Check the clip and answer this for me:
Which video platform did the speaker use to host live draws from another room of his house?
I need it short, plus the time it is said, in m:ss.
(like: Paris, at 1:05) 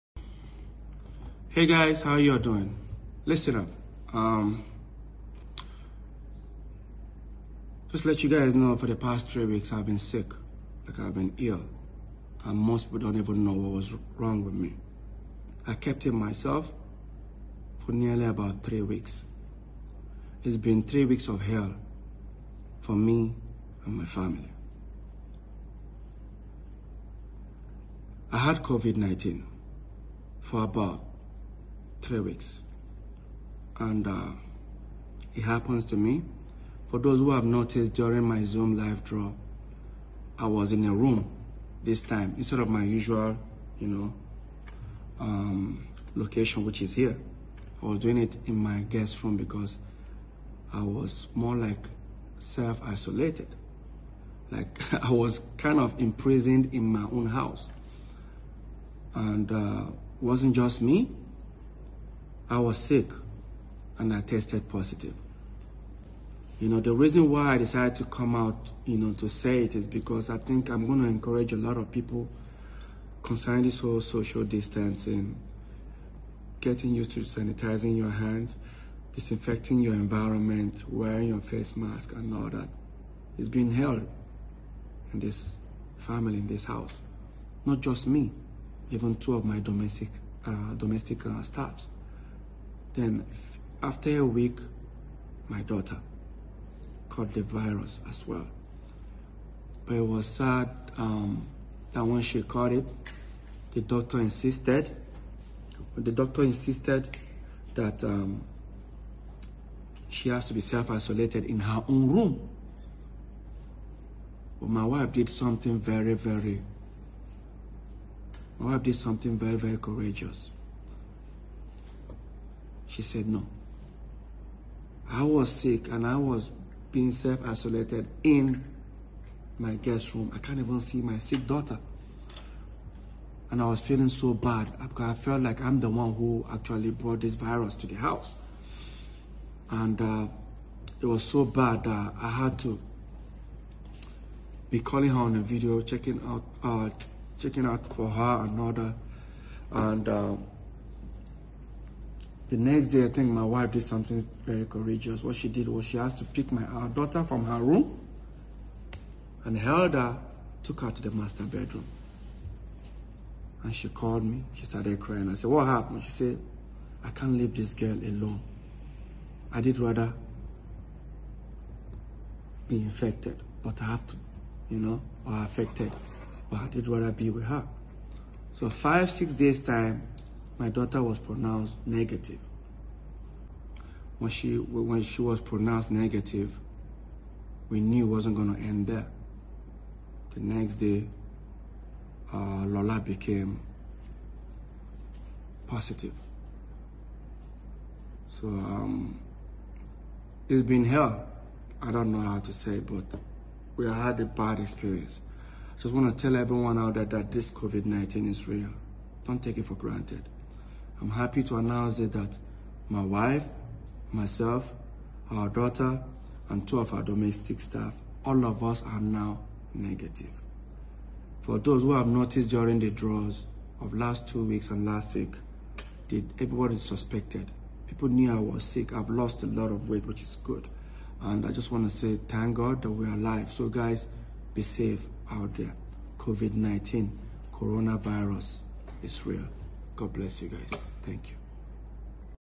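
Zoom, at 0:38.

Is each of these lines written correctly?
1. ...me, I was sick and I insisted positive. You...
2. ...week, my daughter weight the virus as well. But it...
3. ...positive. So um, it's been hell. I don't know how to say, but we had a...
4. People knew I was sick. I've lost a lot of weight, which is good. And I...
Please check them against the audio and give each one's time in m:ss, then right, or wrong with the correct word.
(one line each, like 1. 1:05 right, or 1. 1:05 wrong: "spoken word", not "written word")
1. 1:00 wrong: "tested", not "insisted"
2. 1:34 wrong: "caught", not "weight"
3. 3:15 right
4. 3:47 right.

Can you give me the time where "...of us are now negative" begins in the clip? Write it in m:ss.
3:38.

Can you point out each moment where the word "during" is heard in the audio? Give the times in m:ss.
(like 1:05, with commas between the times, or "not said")
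0:37, 3:42.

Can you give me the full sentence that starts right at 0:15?
I kept it myself for nearly about three weeks.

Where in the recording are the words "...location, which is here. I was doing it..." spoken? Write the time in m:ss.
0:46.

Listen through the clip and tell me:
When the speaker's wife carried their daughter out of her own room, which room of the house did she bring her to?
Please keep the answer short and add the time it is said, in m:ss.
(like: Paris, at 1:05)
master bedroom, at 2:41.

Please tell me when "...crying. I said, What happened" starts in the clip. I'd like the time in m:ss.
2:44.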